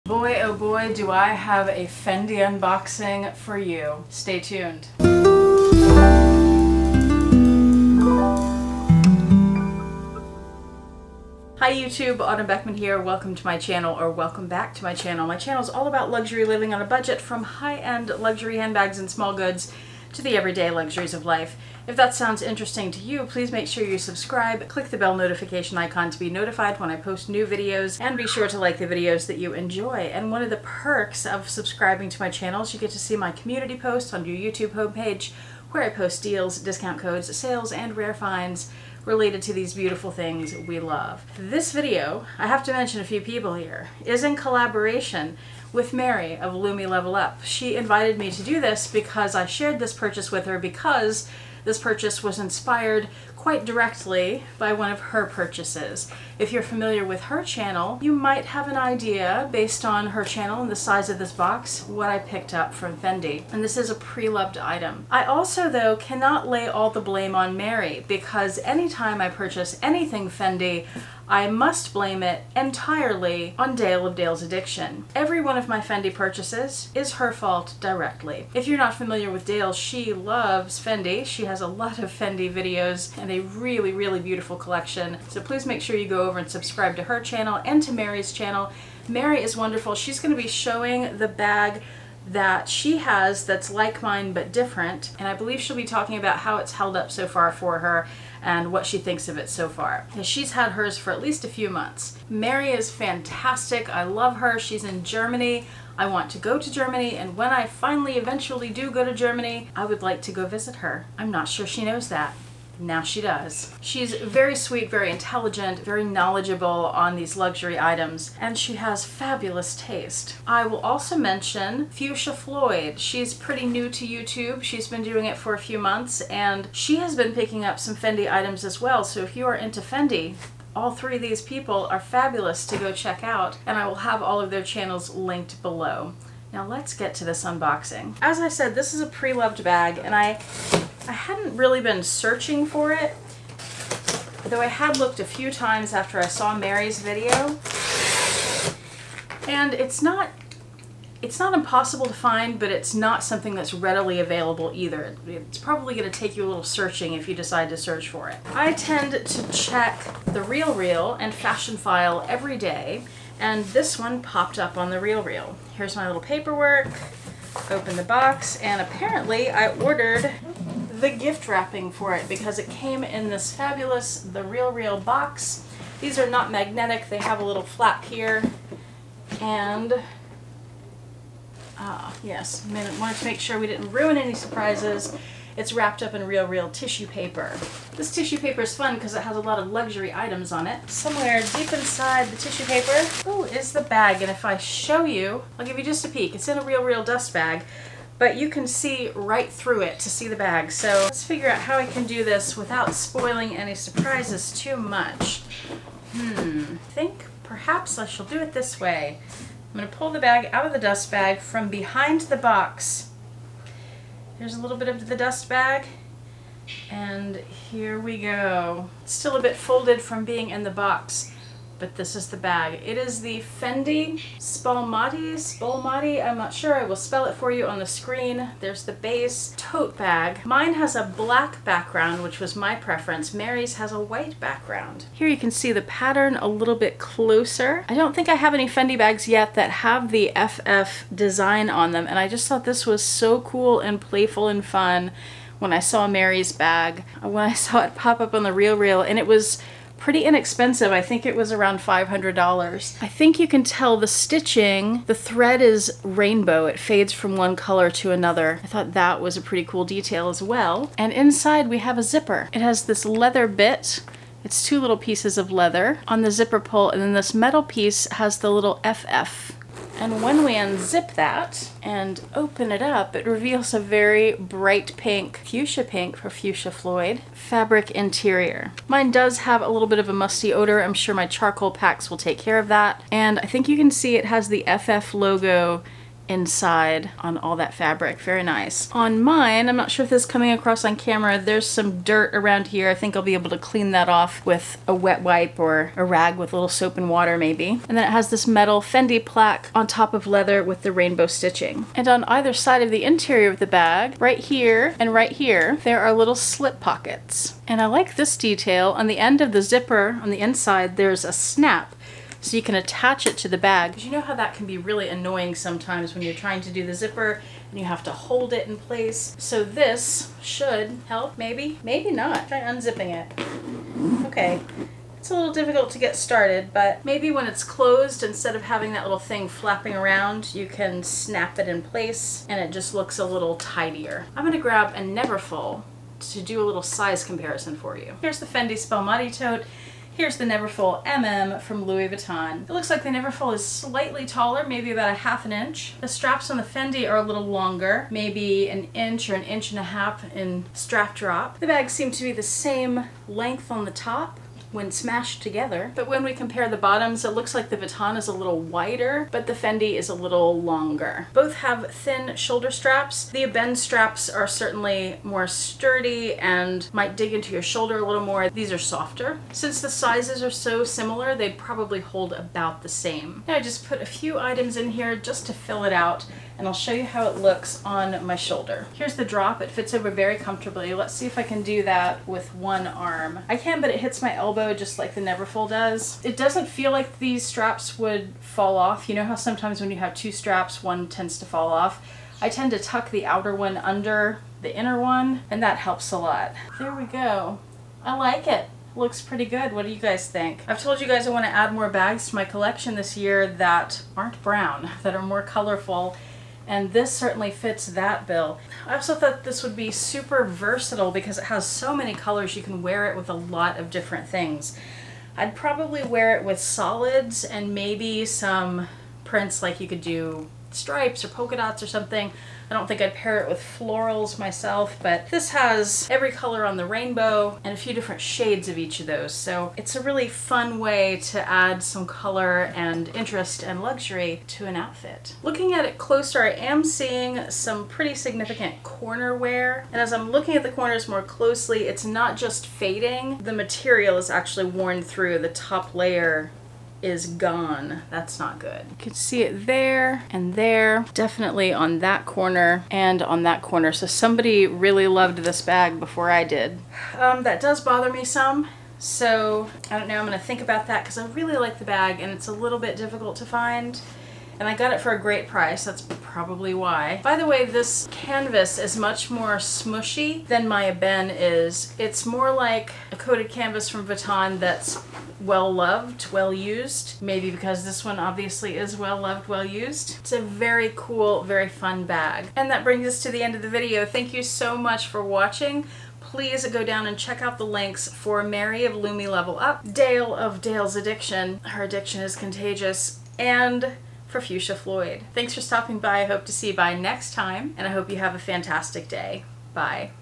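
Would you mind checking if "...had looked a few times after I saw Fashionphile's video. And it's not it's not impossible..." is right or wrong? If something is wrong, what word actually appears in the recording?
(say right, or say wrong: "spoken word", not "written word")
wrong: "Mary", not "Fashionphile".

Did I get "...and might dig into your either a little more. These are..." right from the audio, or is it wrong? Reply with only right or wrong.
wrong.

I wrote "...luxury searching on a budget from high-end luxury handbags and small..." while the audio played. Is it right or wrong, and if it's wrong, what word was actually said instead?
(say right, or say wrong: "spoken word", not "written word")
wrong: "living", not "searching".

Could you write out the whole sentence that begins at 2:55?
These are not magnetic, they have a little flap here.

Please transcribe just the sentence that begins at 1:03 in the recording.
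And this is a pre-loved item.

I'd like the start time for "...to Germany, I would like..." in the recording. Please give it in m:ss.
1:49.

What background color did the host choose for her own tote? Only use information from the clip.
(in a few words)
black.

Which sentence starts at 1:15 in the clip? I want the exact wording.
Every one of my Fendi purchases is her fault directly.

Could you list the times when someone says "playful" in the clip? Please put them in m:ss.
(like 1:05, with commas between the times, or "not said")
4:03.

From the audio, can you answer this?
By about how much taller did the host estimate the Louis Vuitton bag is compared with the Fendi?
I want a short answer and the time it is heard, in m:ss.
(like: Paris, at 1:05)
half an inch, at 5:44.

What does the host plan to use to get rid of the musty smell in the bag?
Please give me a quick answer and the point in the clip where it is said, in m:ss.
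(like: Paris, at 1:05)
charcoal packs, at 4:41.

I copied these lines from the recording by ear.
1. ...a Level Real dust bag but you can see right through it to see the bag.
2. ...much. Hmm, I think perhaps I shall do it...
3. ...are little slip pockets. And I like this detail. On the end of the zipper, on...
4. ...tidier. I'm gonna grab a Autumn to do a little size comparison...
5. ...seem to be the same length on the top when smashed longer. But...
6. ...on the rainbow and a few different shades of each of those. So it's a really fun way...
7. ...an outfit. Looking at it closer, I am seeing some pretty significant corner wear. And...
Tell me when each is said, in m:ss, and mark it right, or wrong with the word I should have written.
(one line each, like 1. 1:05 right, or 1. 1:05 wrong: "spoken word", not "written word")
1. 3:16 wrong: "Real", not "Level"
2. 3:24 right
3. 5:05 right
4. 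5:33 wrong: "Neverfull", not "Autumn"
5. 5:51 wrong: "together", not "longer"
6. 7:06 right
7. 7:14 right.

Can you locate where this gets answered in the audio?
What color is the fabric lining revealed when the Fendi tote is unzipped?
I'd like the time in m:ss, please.
4:35.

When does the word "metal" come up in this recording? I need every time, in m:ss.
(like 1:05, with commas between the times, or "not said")
4:27, 4:58.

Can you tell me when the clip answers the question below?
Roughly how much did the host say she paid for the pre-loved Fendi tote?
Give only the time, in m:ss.
4:10.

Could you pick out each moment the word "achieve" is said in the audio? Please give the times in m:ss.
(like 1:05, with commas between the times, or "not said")
not said.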